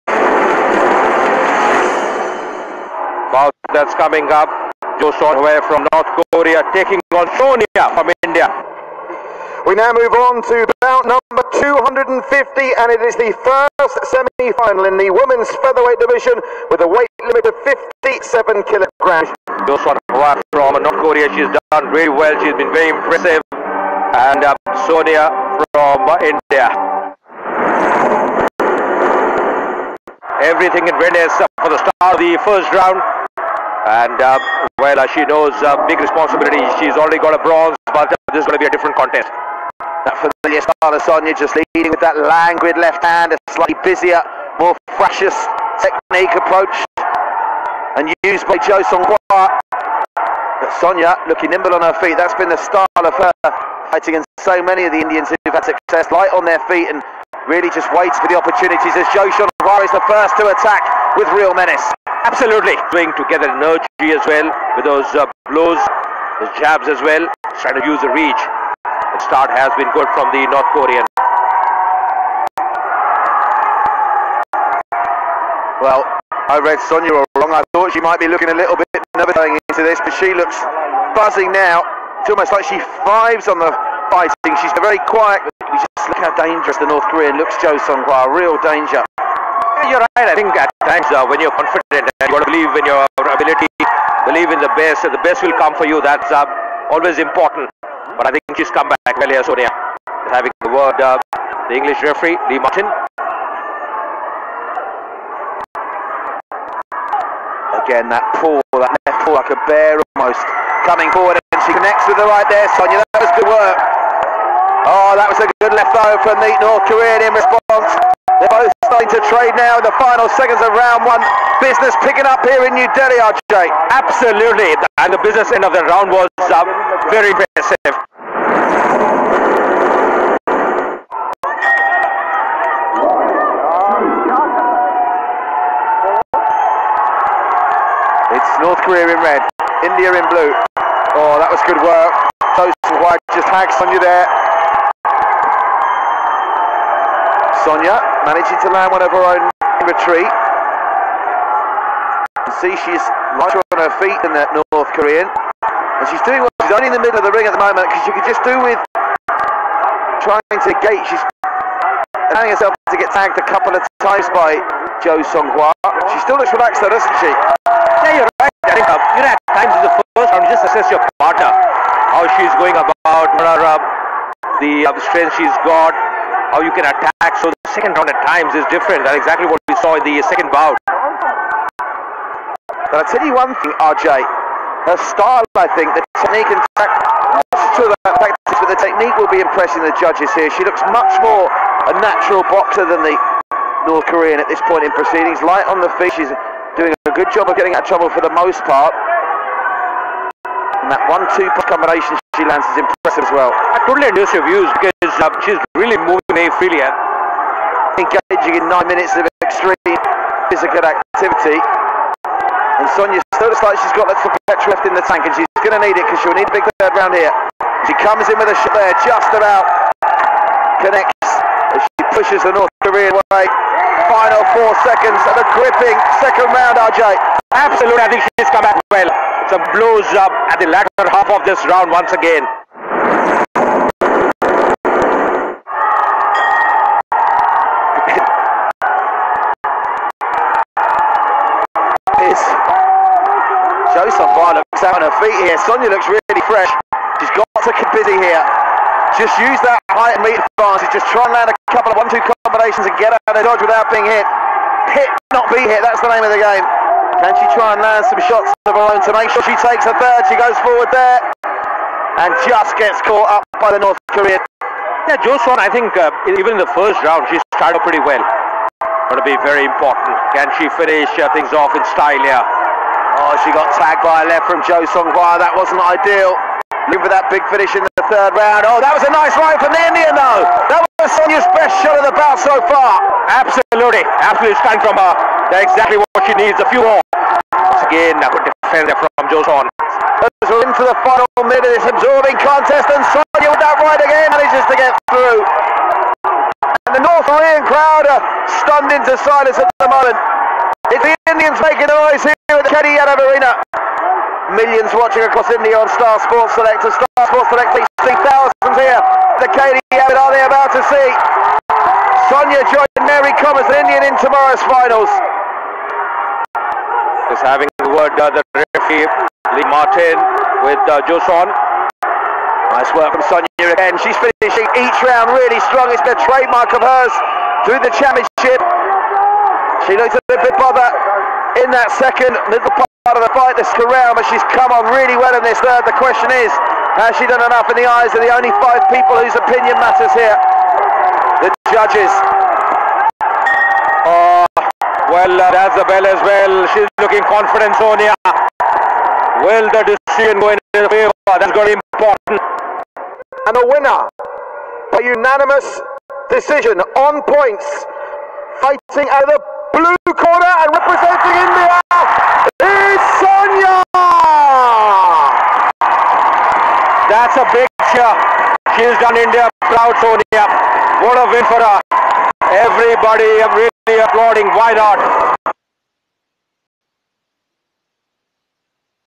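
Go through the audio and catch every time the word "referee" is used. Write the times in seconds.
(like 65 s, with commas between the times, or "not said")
102 s, 318 s.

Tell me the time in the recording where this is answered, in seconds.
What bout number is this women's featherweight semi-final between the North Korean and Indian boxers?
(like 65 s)
10 s.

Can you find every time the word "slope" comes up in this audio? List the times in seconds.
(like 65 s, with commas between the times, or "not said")
not said.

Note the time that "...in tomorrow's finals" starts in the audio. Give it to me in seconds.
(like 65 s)
314 s.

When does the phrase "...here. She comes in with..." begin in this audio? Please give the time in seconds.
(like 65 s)
217 s.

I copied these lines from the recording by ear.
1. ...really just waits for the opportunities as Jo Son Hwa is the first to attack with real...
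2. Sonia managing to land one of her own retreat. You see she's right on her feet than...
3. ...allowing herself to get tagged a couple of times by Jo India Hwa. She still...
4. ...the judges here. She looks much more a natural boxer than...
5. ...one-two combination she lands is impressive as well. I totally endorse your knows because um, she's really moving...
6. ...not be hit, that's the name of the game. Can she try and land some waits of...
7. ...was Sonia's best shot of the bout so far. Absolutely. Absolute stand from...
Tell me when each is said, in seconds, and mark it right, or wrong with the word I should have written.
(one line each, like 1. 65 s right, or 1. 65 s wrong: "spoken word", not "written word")
1. 57 s right
2. 147 s right
3. 162 s wrong: "Son", not "India"
4. 189 s right
5. 201 s wrong: "views", not "knows"
6. 255 s wrong: "shots", not "waits"
7. 280 s right.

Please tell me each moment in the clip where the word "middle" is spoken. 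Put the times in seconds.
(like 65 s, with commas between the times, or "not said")
157 s, 332 s.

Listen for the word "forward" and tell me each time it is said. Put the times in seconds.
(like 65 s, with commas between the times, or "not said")
111 s, 260 s.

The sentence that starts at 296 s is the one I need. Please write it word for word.
And the North Korean crowd are stunned into silence at the moment.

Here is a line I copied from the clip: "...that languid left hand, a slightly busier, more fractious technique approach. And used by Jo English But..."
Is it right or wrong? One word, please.
wrong.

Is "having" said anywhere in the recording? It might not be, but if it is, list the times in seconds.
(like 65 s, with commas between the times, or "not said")
100 s, 317 s.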